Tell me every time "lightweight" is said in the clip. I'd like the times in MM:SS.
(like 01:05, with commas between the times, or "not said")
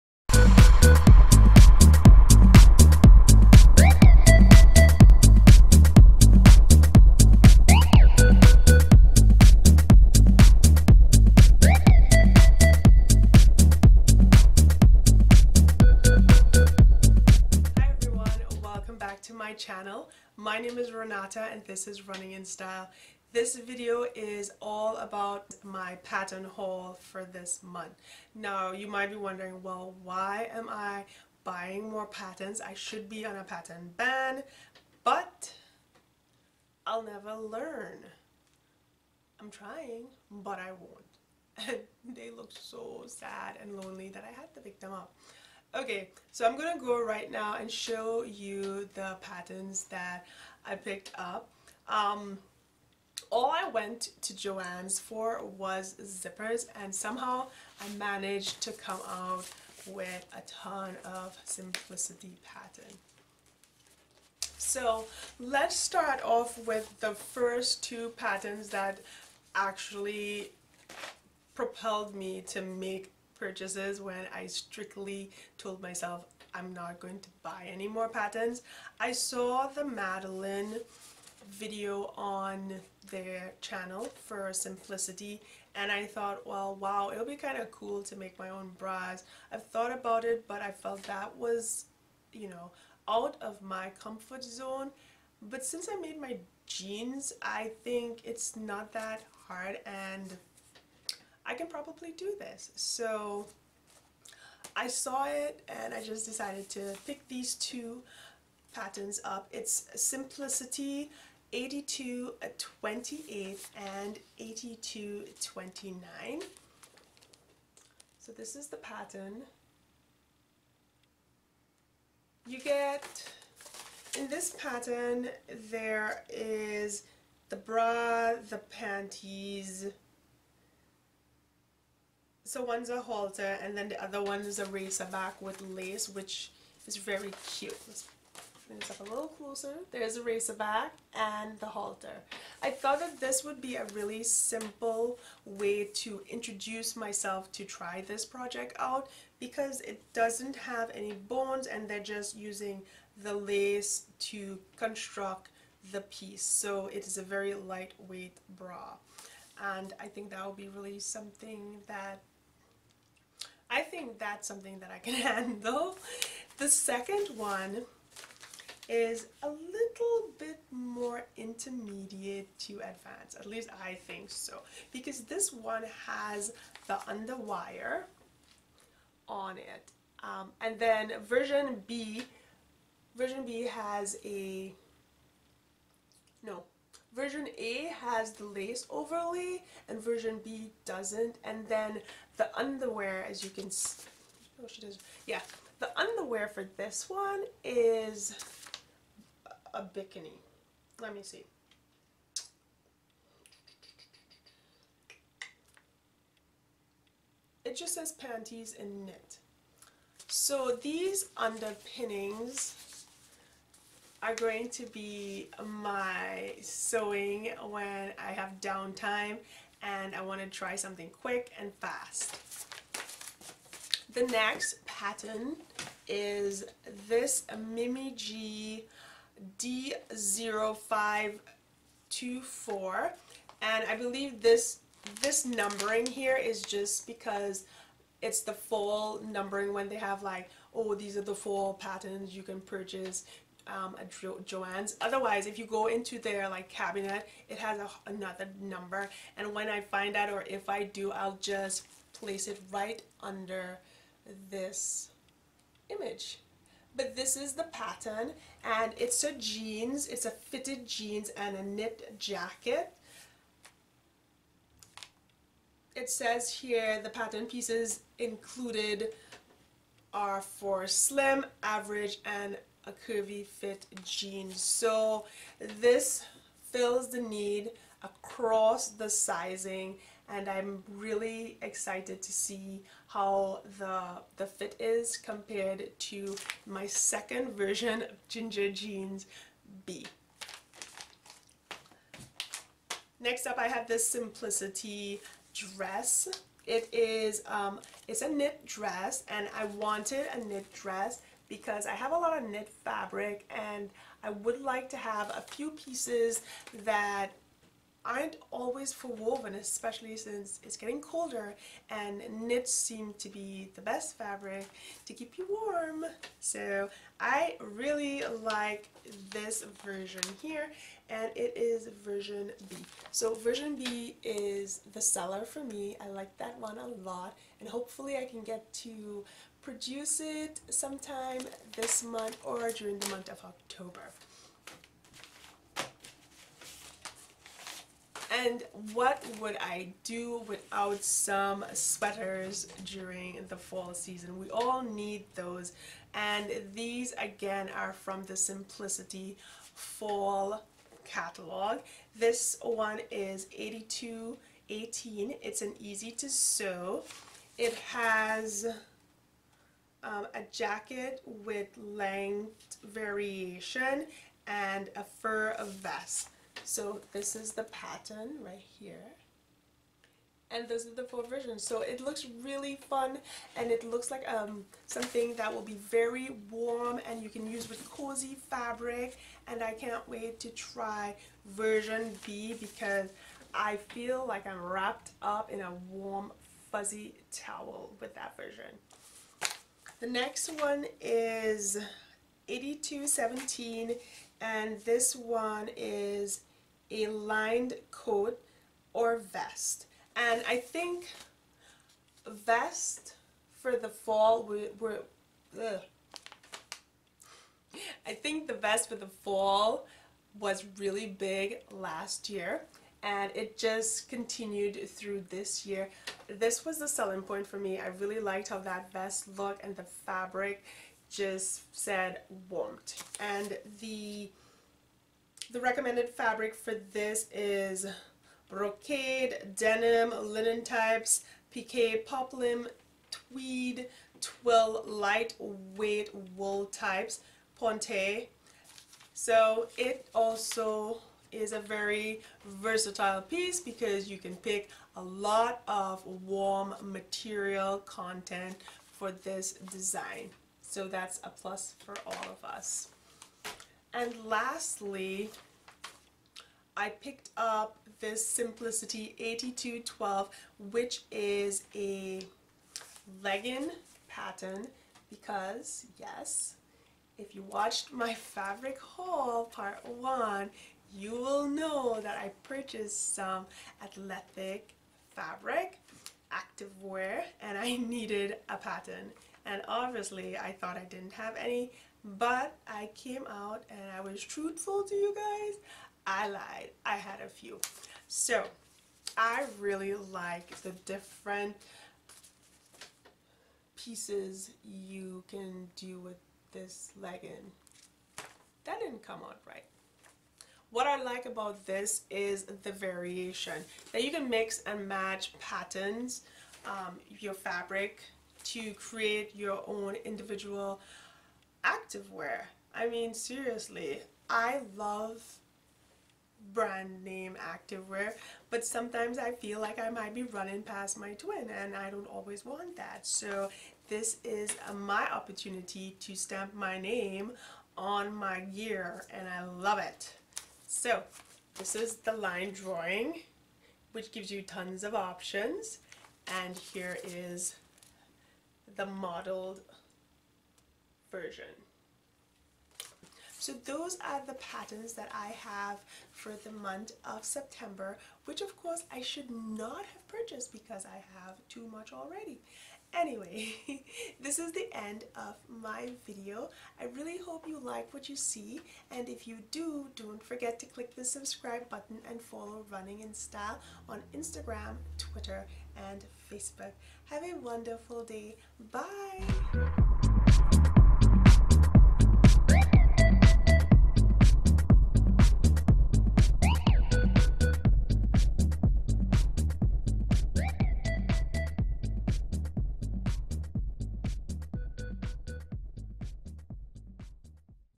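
02:37, 07:14.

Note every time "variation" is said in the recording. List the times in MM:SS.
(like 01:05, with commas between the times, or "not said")
06:02, 08:22.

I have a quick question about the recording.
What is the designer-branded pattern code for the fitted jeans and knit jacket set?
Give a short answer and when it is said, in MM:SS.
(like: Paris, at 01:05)
D0524, at 03:47.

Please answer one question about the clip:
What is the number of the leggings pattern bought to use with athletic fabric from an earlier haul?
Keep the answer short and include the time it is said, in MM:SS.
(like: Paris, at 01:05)
8212, at 07:39.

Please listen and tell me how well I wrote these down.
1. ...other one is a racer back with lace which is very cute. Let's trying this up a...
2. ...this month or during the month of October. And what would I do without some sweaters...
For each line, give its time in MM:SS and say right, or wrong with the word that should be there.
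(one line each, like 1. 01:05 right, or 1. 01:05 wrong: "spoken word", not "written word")
1. 02:14 wrong: "bring", not "trying"
2. 05:31 right.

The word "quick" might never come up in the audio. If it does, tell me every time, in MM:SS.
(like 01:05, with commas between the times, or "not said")
03:41.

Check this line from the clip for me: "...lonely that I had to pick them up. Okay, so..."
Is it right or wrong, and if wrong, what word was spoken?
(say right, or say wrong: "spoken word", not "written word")
right.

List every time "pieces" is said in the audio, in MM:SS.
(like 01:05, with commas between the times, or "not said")
02:36, 04:27, 05:05, 07:23, 08:13.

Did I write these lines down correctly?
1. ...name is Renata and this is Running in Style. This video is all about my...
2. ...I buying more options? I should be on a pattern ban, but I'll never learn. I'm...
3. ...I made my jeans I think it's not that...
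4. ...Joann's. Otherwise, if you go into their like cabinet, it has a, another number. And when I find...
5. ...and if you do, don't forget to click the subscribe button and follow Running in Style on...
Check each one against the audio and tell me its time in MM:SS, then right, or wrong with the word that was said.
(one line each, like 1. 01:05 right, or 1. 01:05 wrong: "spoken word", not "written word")
1. 00:20 right
2. 00:30 wrong: "patterns", not "options"
3. 01:35 right
4. 04:04 right
5. 09:18 right.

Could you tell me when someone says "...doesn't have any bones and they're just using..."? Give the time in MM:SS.
02:30.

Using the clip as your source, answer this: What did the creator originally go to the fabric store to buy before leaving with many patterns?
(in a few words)
Zippers.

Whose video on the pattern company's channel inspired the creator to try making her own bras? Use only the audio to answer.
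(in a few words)
Madalynne.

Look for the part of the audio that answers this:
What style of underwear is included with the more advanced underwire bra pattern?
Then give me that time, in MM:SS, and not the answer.
03:19.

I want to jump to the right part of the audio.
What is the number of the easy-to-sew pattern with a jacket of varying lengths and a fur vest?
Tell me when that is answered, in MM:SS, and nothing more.
05:53.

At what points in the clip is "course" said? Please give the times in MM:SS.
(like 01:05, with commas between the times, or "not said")
09:08.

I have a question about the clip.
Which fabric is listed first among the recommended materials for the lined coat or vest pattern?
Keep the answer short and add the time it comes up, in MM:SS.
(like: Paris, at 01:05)
Brocade, at 07:08.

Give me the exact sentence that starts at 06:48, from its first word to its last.
I think the vest for the fall was really big last year and it just continued through this year.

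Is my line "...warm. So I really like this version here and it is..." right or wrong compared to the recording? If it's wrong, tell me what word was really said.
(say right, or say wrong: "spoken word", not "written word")
right.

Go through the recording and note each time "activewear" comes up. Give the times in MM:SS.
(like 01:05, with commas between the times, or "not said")
07:56, 08:31, 08:37.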